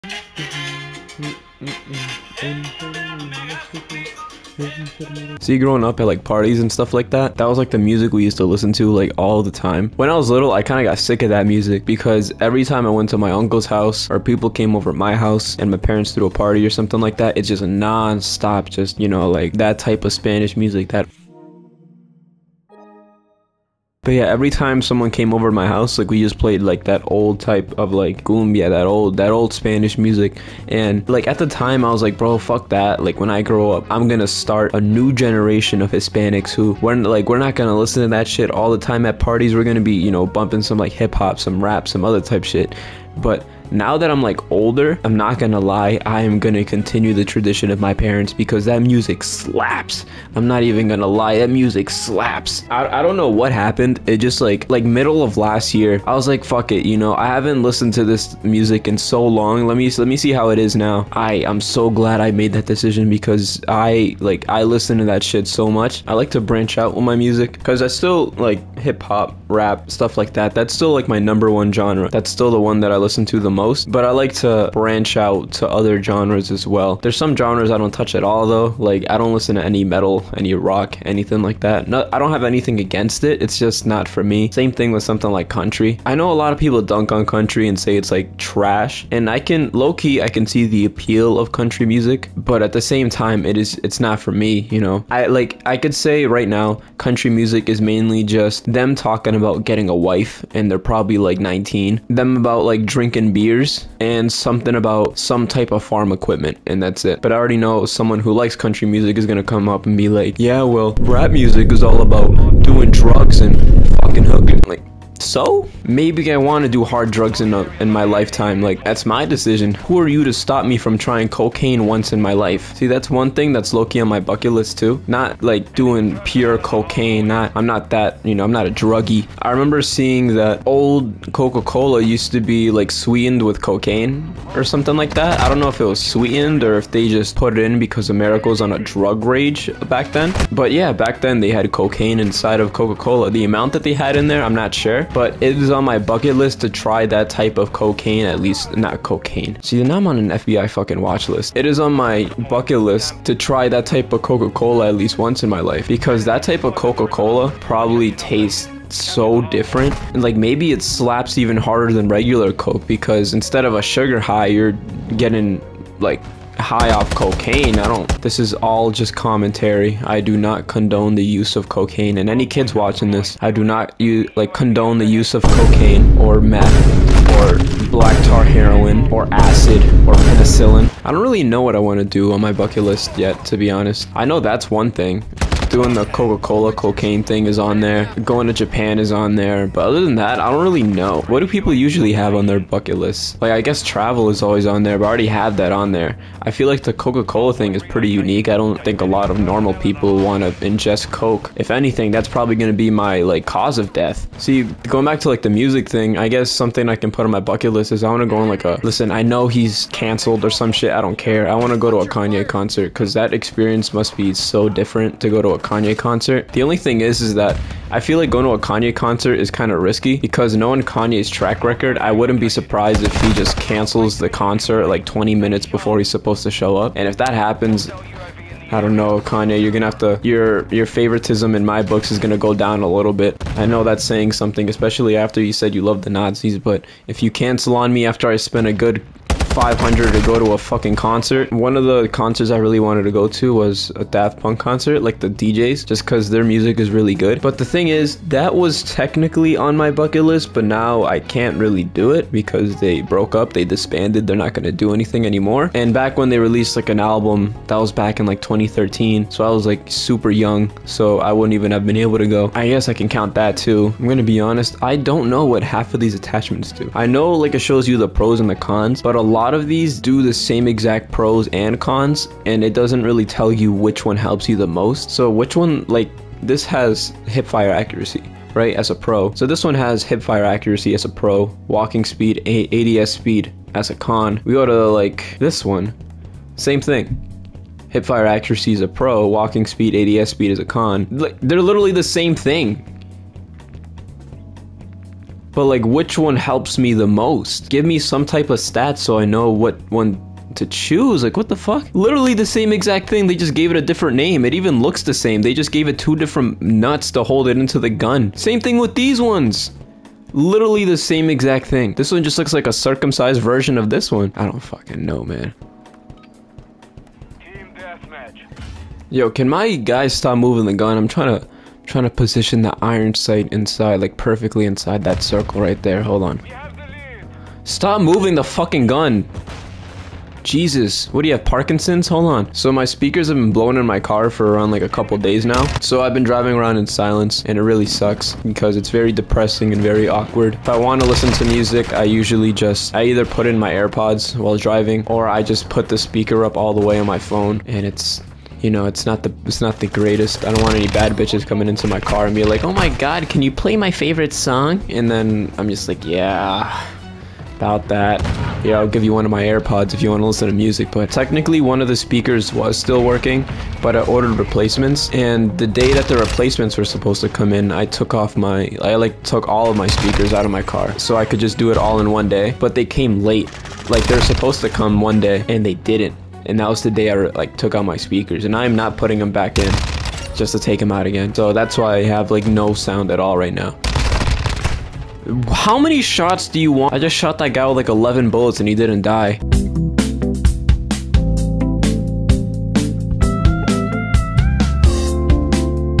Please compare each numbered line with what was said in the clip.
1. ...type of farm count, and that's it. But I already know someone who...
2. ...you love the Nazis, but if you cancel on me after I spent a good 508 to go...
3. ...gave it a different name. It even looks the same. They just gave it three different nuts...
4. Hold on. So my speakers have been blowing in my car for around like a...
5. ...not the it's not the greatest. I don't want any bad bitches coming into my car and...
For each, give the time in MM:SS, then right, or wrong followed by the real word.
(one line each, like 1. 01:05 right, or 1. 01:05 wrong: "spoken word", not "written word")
1. 01:45 wrong: "equipment", not "count"
2. 03:55 wrong: "500", not "508"
3. 05:03 wrong: "two", not "three"
4. 05:32 right
5. 05:49 right.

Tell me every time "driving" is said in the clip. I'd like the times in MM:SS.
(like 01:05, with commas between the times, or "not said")
05:36, 05:44.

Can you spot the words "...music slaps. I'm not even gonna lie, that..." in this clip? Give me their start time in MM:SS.
00:48.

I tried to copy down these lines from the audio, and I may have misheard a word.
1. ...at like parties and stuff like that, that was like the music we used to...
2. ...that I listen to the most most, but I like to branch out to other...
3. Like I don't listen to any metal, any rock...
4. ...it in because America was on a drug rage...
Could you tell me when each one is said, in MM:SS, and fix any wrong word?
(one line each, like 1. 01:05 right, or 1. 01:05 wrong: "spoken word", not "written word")
1. 00:05 right
2. 01:12 right
3. 01:18 right
4. 02:17 right.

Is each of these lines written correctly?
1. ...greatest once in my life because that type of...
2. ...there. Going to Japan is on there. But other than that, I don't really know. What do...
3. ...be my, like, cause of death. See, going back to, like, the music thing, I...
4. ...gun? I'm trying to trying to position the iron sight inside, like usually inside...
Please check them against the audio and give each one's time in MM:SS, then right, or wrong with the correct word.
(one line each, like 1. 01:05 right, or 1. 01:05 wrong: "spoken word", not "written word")
1. 02:34 wrong: "least", not "greatest"
2. 03:07 right
3. 03:22 right
4. 05:20 wrong: "perfectly", not "usually".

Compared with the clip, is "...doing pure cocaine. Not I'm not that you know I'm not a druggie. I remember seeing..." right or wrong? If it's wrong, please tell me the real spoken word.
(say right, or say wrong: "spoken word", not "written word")
right.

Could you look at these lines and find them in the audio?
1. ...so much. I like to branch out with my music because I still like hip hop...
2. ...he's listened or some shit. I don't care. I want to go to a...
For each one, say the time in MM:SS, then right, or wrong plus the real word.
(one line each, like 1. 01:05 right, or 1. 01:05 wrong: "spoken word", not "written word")
1. 01:05 right
2. 03:29 wrong: "canceled", not "listened".